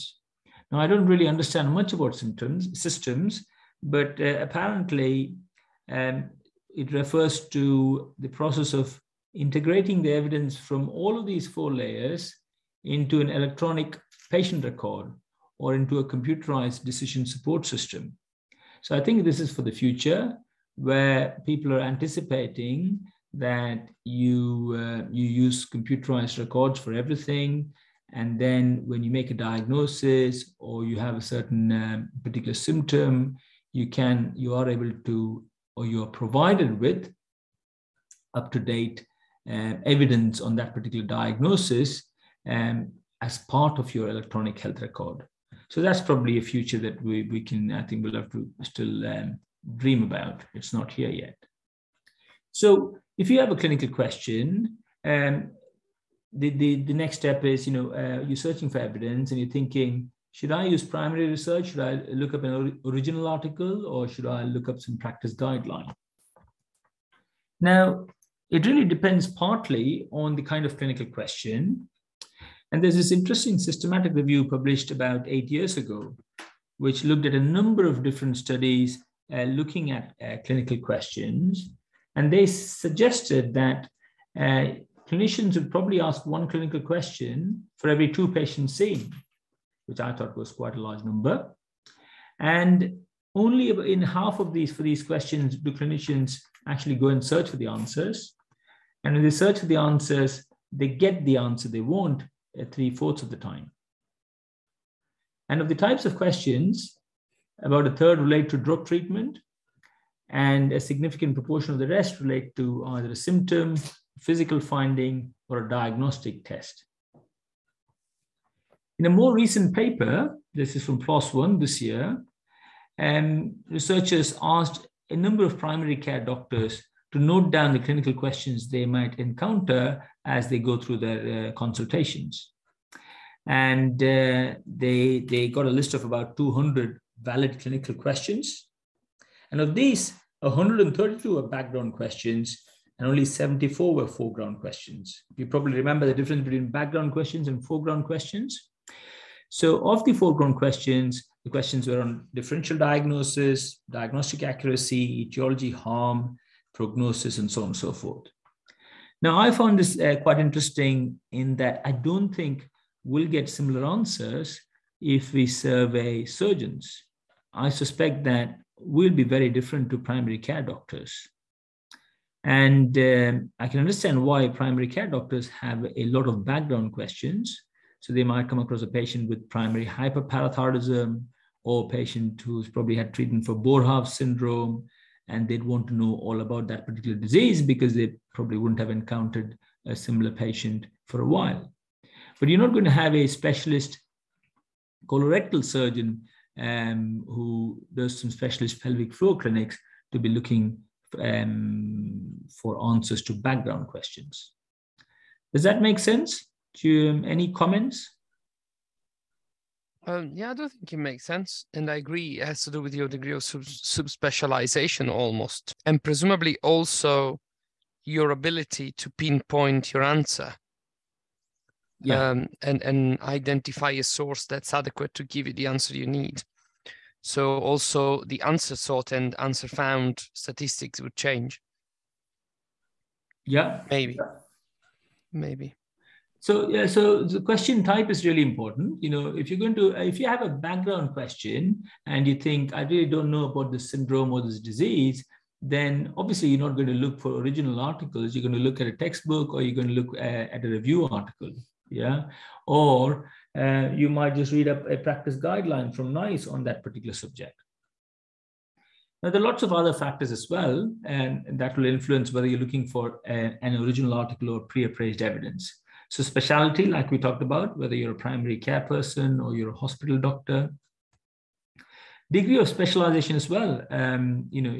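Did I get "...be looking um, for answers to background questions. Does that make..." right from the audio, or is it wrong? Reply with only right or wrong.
right.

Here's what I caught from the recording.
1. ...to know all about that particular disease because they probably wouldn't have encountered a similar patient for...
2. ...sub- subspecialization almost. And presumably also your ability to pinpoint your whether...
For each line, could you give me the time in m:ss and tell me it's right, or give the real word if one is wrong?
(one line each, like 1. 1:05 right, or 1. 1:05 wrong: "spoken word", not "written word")
1. 3:05 right
2. 3:33 wrong: "answer", not "whether".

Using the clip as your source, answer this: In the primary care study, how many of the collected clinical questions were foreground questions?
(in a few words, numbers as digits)
74.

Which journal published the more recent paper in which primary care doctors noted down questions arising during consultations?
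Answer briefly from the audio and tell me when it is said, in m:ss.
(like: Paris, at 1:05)
PLOS One, at 2:01.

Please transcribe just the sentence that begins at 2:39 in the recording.
Now, I found this uh, quite interesting in that I don't think we'll get similar answers if we survey surgeons.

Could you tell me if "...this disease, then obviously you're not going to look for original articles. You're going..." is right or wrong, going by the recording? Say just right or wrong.
right.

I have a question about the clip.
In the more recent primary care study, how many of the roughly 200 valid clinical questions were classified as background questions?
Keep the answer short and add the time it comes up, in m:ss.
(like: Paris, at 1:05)
132, at 2:20.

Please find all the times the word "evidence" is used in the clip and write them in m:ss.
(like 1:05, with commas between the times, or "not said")
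0:10, 0:39, 0:58, 4:25.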